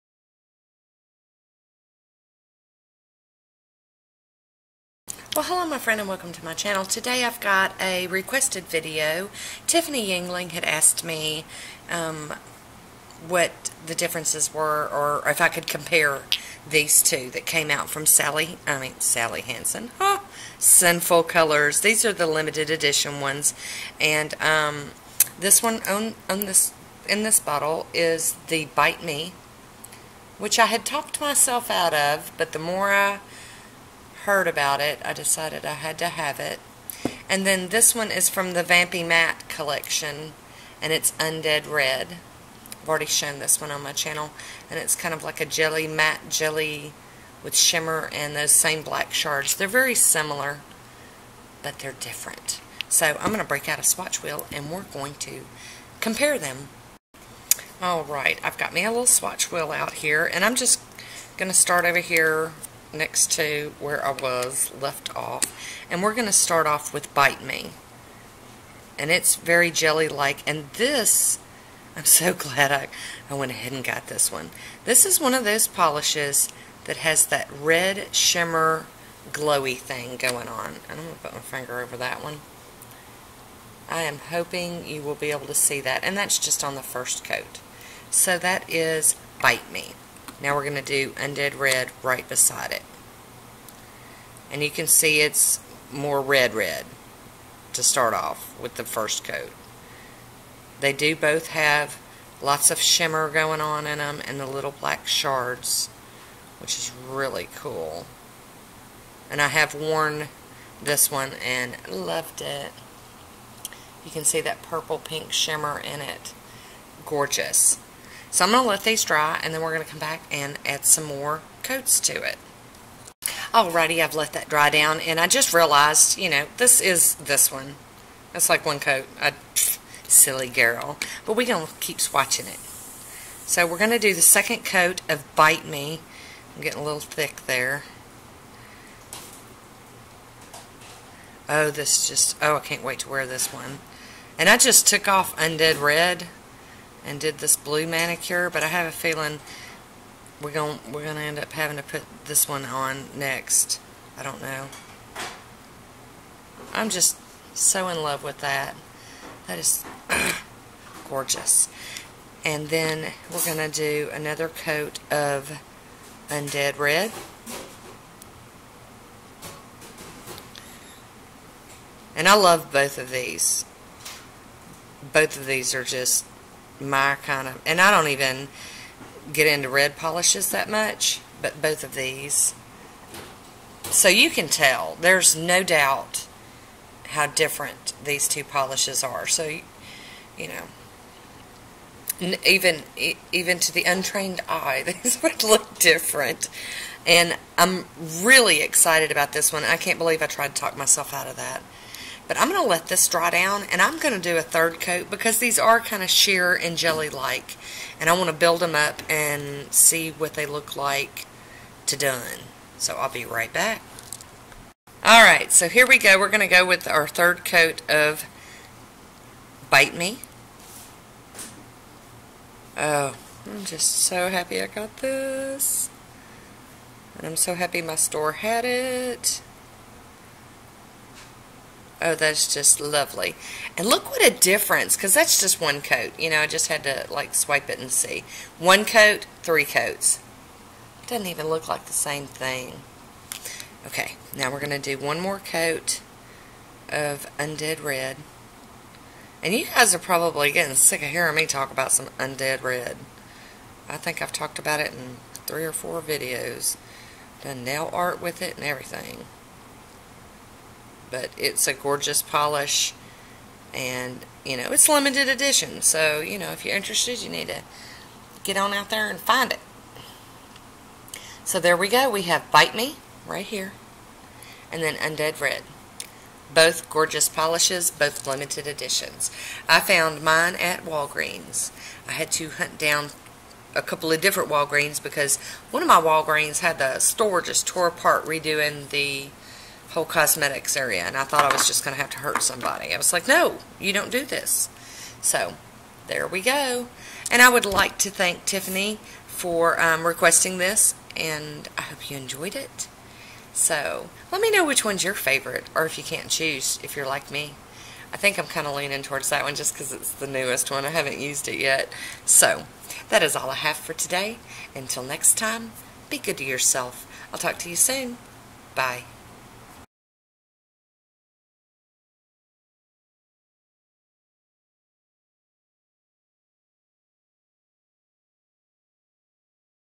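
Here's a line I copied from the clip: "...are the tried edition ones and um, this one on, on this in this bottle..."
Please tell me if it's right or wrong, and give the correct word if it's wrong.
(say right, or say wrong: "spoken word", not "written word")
wrong: "limited", not "tried".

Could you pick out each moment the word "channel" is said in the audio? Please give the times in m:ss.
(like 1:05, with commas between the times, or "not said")
0:06, 0:43.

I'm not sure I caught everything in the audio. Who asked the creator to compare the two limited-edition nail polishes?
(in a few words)
Tiffany Yingling.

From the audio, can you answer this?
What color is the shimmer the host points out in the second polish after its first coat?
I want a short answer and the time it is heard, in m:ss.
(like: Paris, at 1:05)
purple pink, at 1:54.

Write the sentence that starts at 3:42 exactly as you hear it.
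Oh, I'm just so happy I got this.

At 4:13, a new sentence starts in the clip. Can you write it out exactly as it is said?
I think I've talked about it in three or four videos.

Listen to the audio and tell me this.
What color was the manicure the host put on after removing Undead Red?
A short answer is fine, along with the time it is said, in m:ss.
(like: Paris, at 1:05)
blue, at 2:27.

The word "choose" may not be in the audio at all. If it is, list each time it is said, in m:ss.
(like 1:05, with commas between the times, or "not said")
5:06.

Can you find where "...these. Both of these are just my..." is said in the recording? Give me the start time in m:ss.
2:53.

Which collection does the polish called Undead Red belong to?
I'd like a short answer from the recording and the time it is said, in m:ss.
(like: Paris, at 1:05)
Vampy Matte, at 0:38.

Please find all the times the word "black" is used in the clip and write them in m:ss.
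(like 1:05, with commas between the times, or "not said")
0:48, 1:44.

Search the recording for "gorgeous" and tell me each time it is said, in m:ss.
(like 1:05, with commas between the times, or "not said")
1:57, 2:41, 4:21, 4:36.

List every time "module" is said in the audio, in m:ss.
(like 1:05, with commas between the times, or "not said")
not said.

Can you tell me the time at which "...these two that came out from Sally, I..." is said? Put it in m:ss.
0:16.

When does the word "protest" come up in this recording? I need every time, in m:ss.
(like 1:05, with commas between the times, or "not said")
not said.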